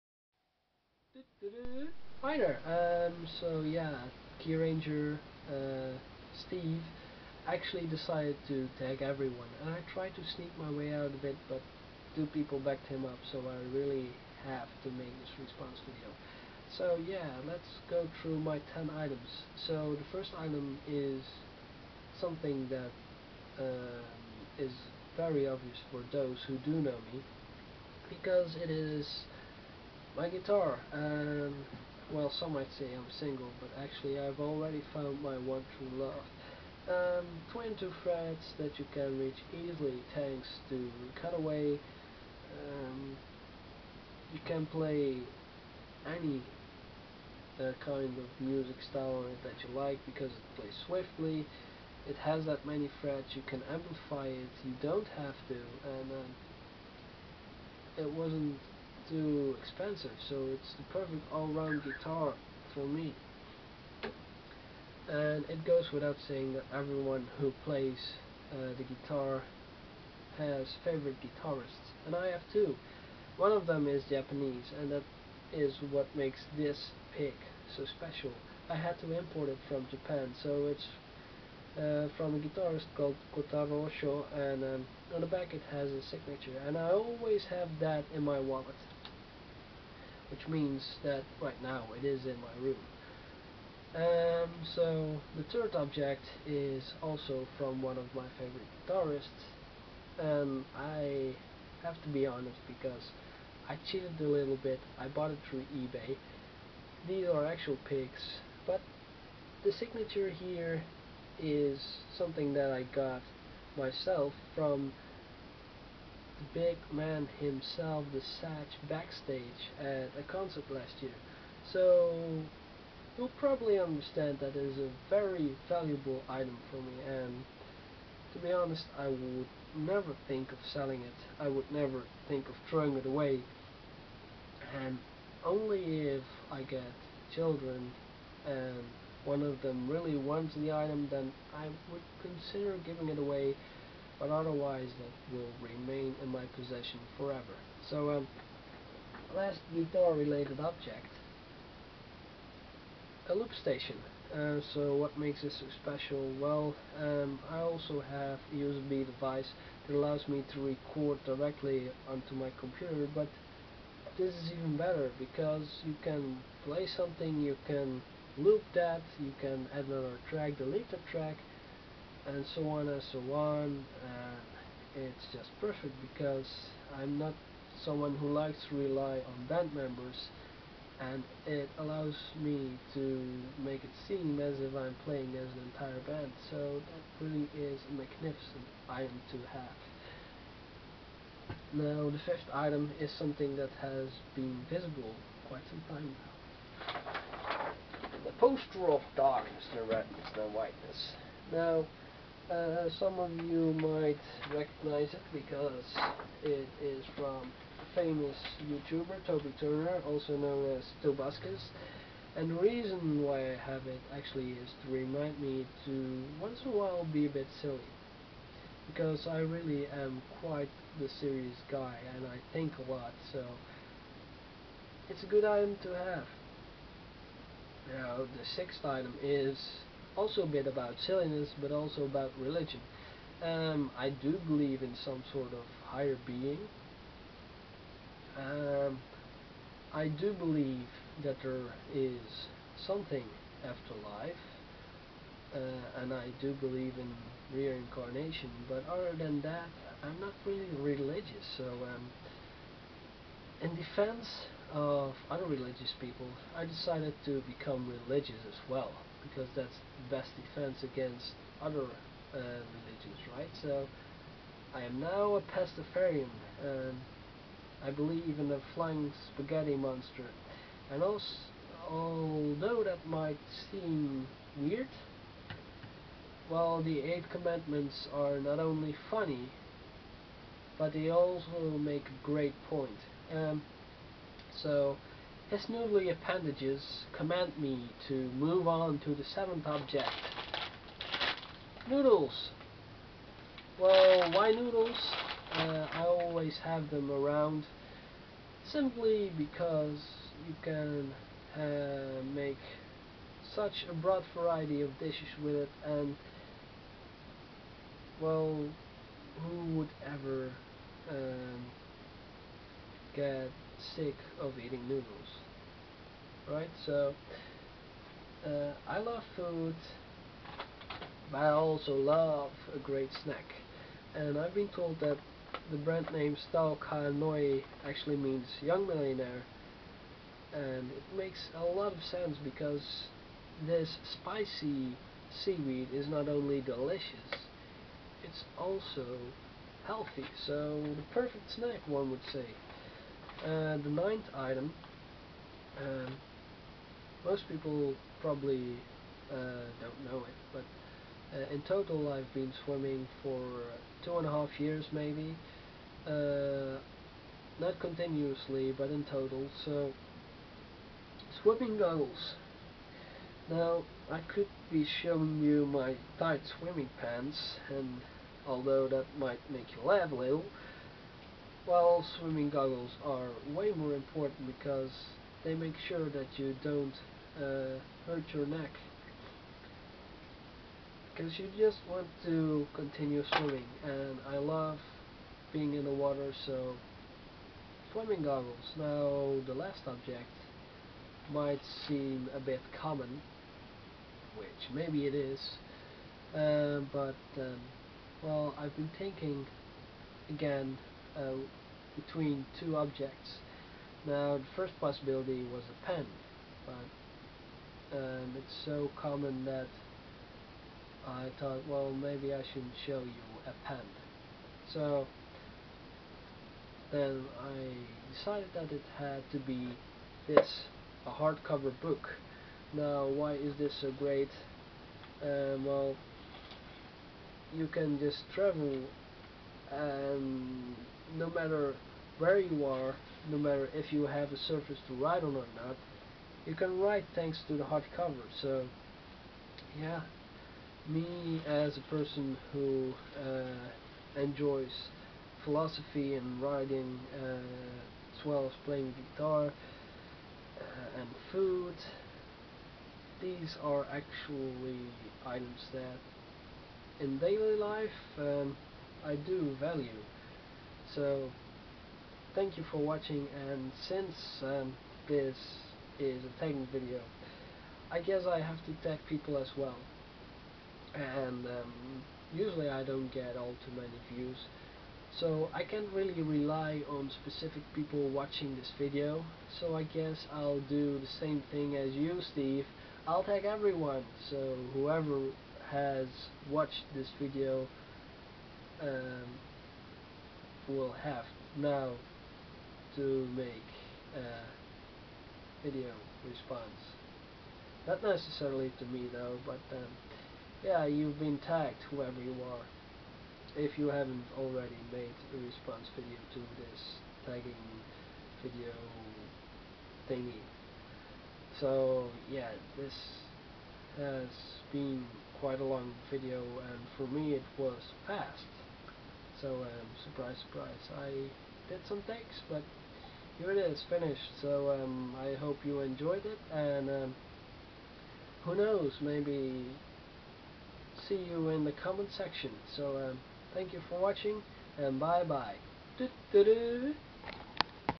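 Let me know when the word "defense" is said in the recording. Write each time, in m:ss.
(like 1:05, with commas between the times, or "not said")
4:13, 4:20.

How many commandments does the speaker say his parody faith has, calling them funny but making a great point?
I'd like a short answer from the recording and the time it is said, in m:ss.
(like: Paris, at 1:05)
8, at 4:36.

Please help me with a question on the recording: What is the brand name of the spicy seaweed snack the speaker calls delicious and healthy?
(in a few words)
Tao Kae Noi.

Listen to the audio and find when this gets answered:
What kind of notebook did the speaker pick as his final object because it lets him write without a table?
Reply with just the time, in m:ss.
7:01.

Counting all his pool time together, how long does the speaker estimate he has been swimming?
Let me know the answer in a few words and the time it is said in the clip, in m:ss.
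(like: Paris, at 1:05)
two and a half years, at 5:54.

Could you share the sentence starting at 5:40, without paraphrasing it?
So the perfect snack one would say.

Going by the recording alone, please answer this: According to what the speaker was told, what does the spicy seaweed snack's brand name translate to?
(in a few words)
young millionaire.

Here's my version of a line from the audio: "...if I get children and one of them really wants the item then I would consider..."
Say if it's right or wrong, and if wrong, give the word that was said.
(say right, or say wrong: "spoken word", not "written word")
right.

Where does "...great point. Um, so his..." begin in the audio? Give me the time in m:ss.
4:42.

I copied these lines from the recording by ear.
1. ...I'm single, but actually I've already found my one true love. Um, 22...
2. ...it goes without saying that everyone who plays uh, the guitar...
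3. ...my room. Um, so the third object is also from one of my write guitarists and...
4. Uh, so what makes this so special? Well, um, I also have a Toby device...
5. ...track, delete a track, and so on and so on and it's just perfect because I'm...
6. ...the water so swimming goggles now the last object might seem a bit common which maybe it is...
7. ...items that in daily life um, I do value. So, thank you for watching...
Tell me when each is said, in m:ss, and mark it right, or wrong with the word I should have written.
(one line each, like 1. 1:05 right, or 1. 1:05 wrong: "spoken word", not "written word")
1. 0:32 right
2. 1:05 right
3. 1:32 wrong: "favorite", not "write"
4. 2:34 wrong: "USB", not "Toby"
5. 2:50 right
6. 6:25 right
7. 7:35 right.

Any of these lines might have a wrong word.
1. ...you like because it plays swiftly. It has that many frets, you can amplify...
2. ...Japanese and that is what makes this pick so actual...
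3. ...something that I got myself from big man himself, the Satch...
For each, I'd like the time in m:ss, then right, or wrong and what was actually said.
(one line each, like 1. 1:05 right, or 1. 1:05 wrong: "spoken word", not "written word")
1. 0:49 right
2. 1:14 wrong: "special", not "actual"
3. 1:52 right.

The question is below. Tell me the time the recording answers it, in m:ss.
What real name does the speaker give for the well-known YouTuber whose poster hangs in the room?
3:29.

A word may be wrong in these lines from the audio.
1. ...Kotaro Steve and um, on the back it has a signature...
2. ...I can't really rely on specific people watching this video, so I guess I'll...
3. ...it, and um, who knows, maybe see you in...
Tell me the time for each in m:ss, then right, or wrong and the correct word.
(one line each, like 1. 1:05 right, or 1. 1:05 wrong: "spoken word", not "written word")
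1. 1:23 wrong: "Oshio", not "Steve"
2. 7:55 right
3. 8:46 right.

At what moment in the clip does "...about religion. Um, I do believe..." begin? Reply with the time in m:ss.
3:52.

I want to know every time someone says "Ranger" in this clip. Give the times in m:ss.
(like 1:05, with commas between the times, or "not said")
0:04.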